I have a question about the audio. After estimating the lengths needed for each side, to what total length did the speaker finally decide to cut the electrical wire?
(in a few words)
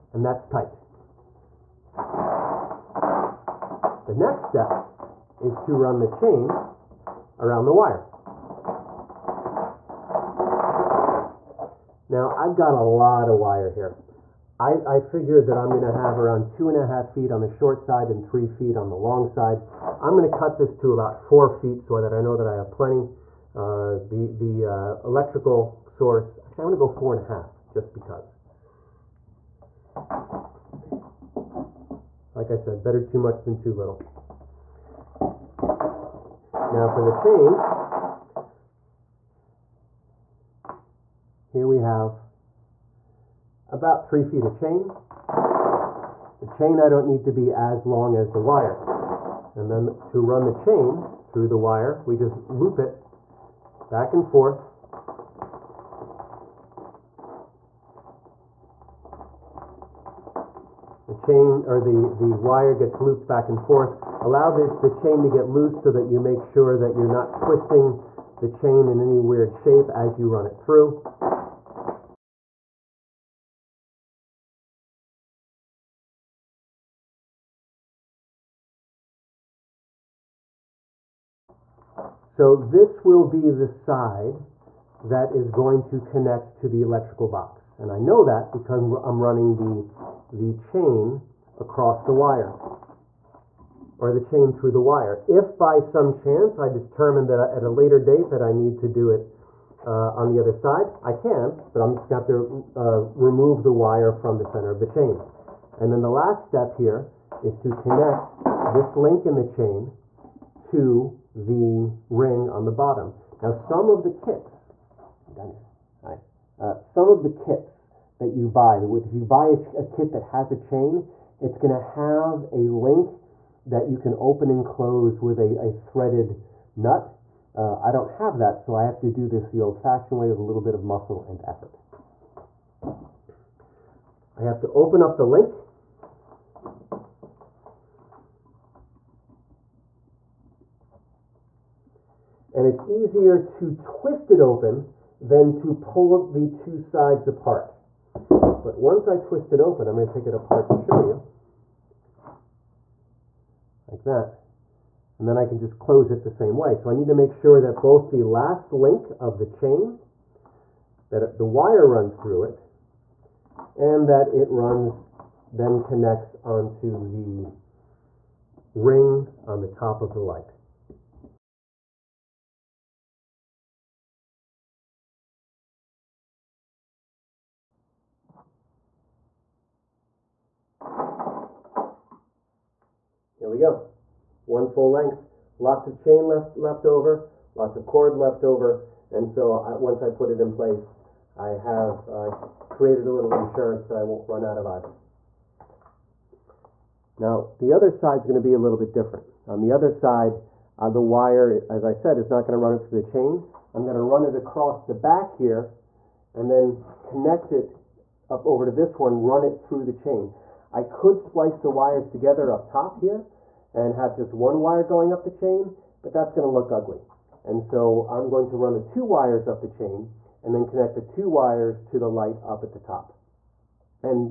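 4.5 feet.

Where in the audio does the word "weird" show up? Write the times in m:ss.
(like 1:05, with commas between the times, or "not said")
1:09.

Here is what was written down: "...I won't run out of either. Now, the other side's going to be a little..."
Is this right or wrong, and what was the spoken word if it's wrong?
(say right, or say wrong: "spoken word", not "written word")
right.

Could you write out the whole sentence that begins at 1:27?
And I know that because I'm running the, the chain across the wire or the chain through the wire.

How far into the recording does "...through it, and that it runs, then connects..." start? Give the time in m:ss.
2:42.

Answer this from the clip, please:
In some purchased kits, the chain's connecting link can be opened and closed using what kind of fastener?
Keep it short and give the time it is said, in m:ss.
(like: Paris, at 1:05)
Threaded nut, at 2:05.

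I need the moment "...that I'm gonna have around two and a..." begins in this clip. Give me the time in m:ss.
0:15.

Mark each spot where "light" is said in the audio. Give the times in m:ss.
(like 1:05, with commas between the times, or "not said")
2:50, 3:42.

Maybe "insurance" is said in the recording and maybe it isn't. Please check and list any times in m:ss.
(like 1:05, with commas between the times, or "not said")
3:13.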